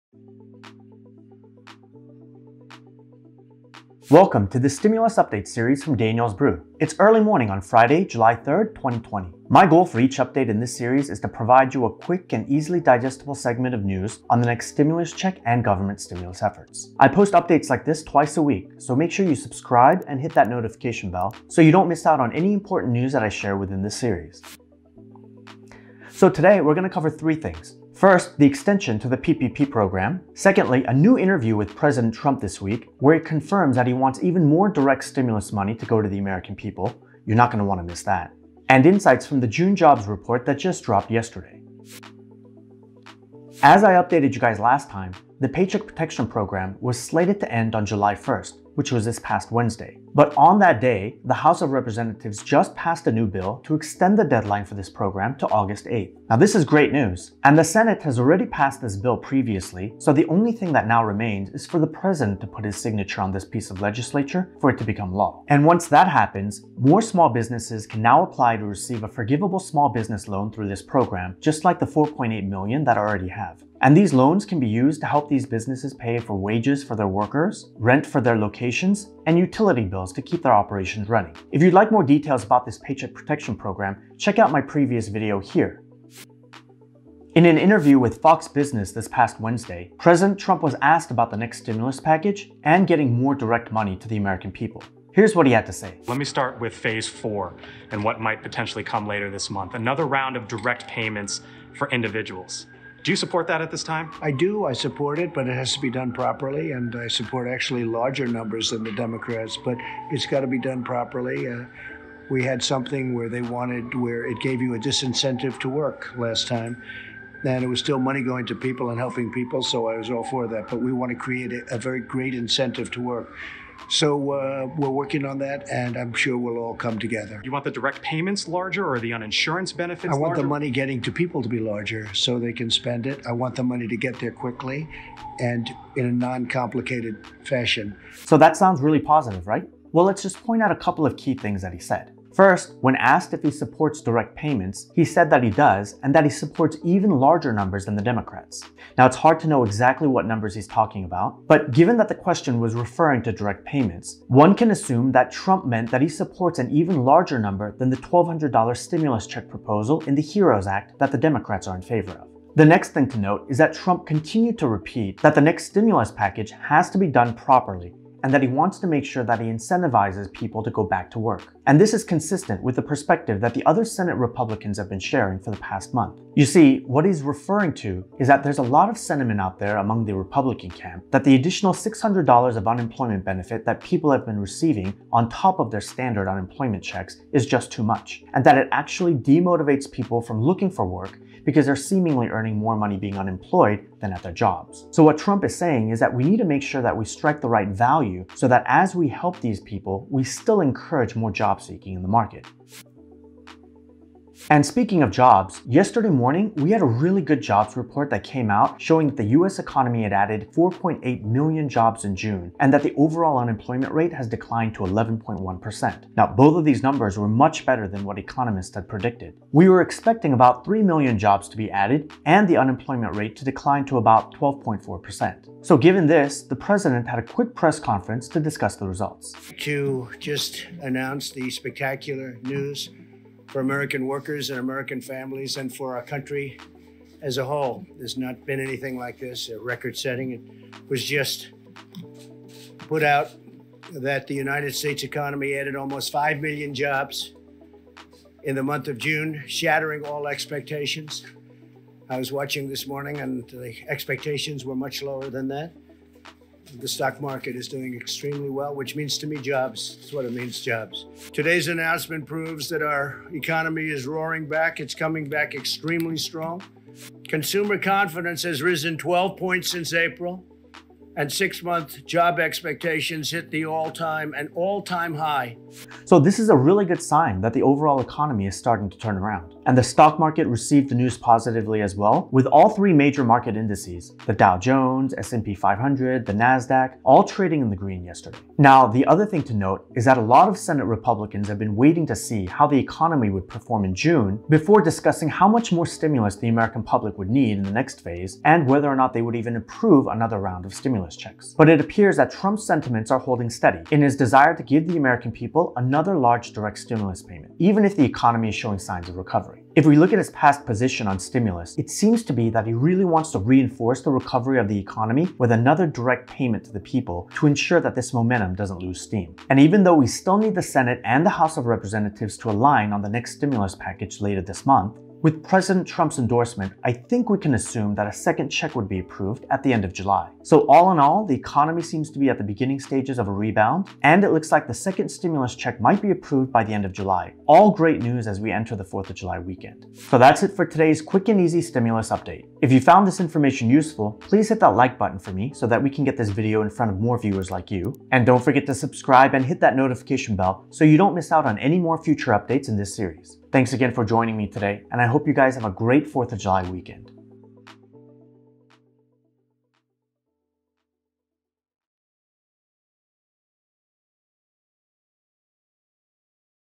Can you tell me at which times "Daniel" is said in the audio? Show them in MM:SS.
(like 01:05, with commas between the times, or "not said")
00:05.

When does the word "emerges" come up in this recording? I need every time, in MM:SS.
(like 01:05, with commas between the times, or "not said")
not said.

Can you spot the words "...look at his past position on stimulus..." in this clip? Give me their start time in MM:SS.
05:09.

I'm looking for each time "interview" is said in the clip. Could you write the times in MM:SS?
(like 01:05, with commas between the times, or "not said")
00:31, 01:27.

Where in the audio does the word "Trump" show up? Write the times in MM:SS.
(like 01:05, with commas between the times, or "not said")
00:32, 01:30, 02:35, 02:43, 03:15, 05:02, 05:25.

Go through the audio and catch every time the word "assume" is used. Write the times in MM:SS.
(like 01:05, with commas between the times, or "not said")
02:34, 05:27.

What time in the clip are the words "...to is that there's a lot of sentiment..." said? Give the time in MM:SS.
02:57.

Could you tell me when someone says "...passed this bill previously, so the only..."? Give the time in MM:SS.
00:58.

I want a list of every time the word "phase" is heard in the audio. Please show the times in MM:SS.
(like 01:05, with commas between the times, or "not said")
01:36, 04:58.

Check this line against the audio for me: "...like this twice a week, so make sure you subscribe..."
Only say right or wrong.
right.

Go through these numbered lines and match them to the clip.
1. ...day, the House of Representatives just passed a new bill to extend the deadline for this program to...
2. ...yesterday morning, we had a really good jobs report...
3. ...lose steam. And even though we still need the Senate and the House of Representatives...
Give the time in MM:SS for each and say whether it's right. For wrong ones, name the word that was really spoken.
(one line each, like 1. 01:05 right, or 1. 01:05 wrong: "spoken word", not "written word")
1. 00:50 right
2. 03:25 right
3. 05:18 right.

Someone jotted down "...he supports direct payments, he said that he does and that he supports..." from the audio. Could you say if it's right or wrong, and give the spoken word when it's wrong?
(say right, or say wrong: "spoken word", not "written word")
right.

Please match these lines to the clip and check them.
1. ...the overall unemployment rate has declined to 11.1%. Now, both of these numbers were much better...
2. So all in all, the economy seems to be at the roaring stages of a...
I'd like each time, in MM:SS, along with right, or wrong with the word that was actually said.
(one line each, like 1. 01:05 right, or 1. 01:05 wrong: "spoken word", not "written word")
1. 03:32 right
2. 05:30 wrong: "beginning", not "roaring".